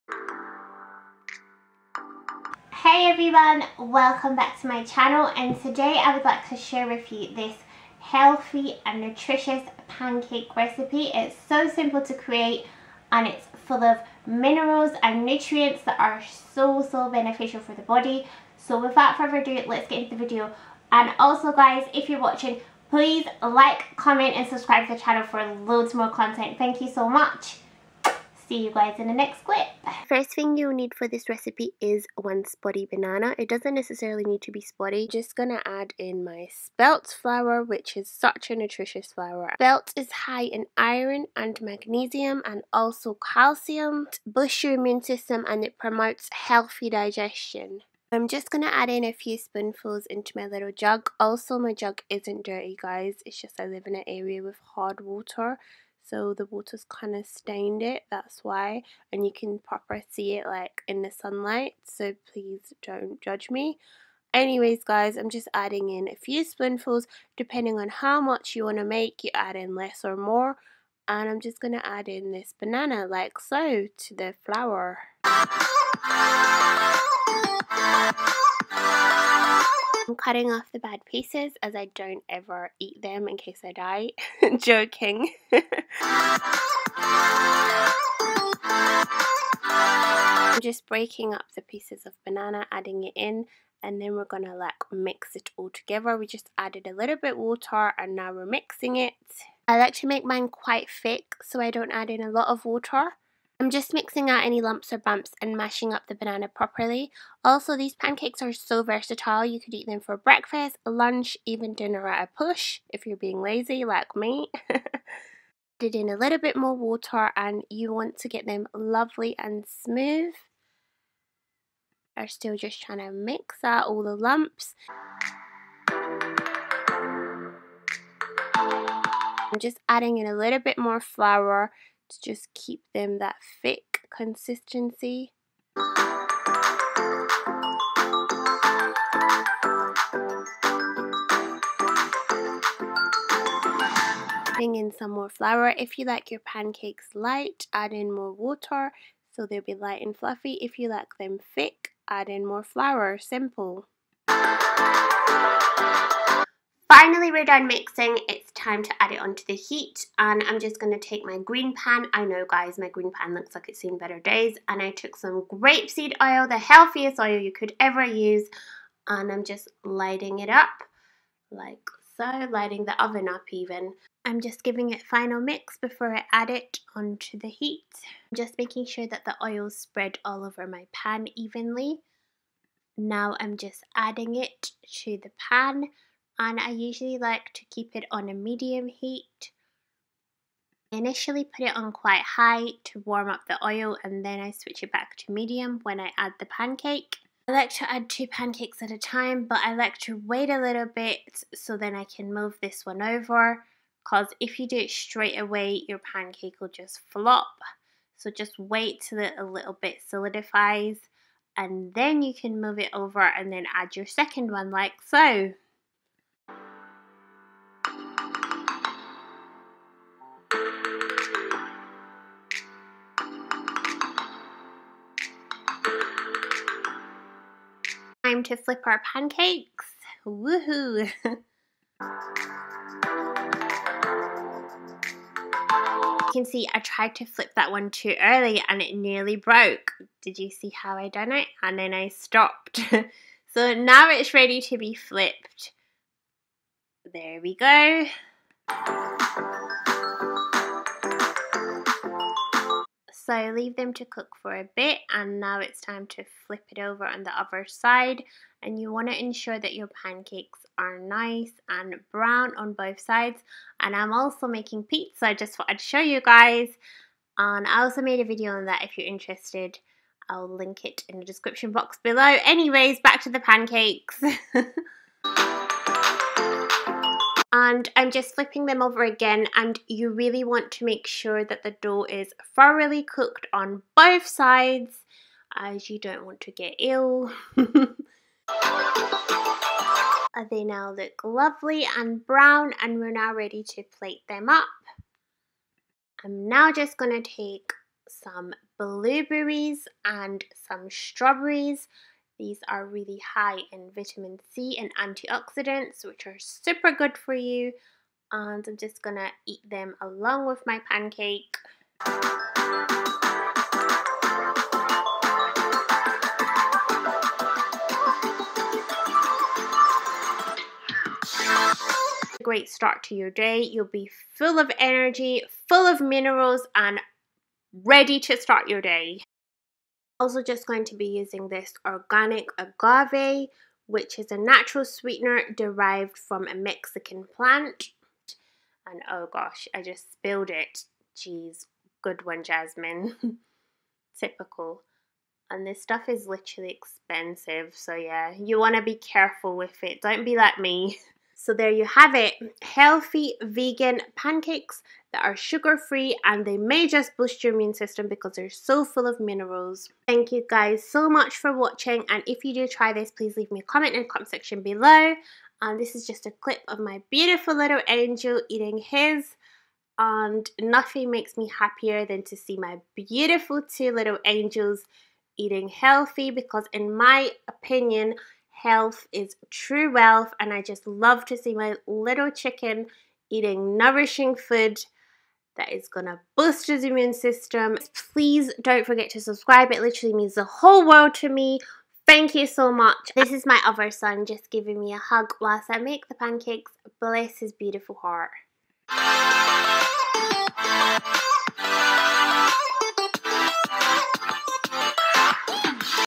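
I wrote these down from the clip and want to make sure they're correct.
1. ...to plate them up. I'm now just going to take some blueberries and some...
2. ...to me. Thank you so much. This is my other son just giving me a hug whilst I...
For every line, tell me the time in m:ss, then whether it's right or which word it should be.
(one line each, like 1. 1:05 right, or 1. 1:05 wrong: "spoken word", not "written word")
1. 4:53 right
2. 6:31 right.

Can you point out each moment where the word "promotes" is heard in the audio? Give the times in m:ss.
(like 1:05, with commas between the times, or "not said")
0:45.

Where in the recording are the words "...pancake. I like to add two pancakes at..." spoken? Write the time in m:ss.
3:16.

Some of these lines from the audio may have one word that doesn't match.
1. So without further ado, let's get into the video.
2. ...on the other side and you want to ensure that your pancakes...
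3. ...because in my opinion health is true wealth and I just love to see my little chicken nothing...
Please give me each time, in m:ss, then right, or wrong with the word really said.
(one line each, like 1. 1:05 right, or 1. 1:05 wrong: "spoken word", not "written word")
1. 0:18 right
2. 4:17 right
3. 6:16 wrong: "eating", not "nothing".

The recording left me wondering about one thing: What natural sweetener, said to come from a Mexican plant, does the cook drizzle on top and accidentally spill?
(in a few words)
Organic agave.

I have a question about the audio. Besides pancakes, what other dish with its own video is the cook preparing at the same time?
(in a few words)
Pizza.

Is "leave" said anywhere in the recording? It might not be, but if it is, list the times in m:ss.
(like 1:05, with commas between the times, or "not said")
4:13, 6:03.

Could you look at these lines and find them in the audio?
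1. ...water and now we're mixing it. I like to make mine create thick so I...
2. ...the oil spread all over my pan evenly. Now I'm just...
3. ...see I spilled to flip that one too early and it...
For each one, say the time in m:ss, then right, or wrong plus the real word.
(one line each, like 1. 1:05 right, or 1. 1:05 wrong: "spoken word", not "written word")
1. 1:37 wrong: "quite", not "create"
2. 2:59 right
3. 3:56 wrong: "tried", not "spilled".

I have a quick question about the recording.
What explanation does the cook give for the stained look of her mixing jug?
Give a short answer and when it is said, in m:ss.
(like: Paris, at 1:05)
Hard water, at 0:54.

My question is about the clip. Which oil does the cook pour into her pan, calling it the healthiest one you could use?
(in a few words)
Grapeseed oil.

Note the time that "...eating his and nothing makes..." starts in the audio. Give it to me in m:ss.
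6:08.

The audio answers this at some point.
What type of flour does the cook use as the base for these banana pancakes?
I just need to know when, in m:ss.
0:36.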